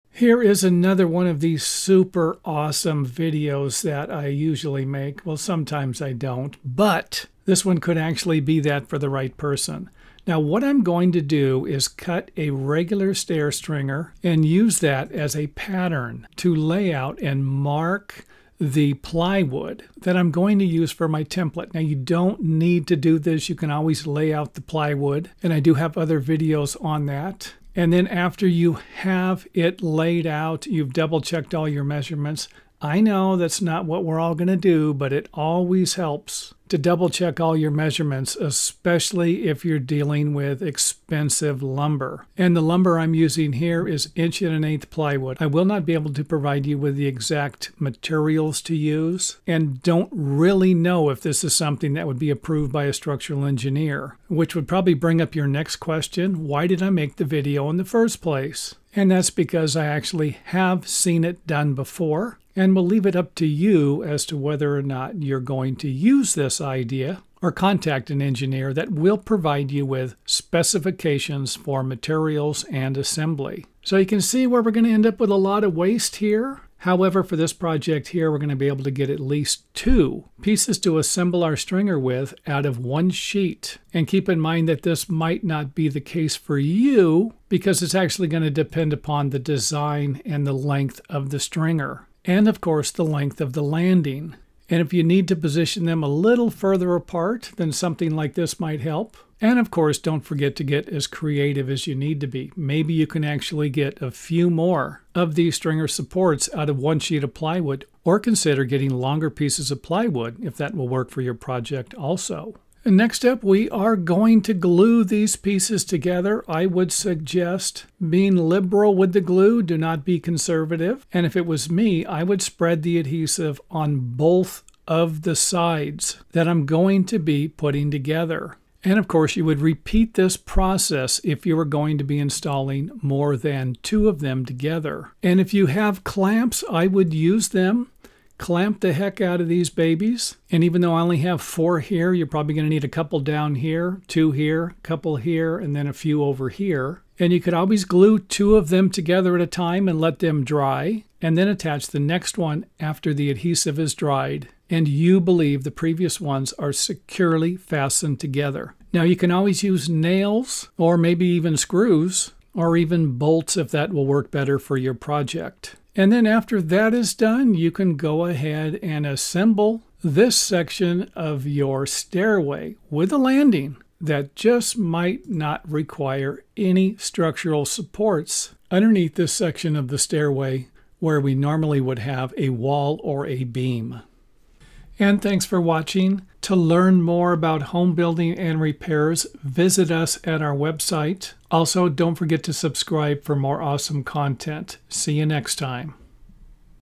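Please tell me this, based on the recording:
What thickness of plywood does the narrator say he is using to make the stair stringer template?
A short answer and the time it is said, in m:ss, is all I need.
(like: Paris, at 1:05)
1 1/8 inch, at 0:44.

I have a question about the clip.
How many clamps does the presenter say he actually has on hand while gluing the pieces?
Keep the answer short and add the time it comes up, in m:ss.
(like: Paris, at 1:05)
4, at 2:21.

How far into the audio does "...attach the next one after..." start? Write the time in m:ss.
2:31.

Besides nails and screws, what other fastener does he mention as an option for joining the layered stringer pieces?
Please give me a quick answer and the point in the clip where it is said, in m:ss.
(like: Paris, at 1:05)
Bolts, at 2:43.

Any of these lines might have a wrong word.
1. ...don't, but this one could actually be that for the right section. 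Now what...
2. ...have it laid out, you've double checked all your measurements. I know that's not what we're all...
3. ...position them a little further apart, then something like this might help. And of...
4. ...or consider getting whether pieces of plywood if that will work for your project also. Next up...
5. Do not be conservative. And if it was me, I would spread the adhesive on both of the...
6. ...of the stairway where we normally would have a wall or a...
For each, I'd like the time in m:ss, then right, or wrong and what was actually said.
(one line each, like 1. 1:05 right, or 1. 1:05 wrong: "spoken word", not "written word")
1. 0:06 wrong: "person", not "section"
2. 0:28 right
3. 1:35 right
4. 1:48 wrong: "longer", not "whether"
5. 1:59 right
6. 2:59 right.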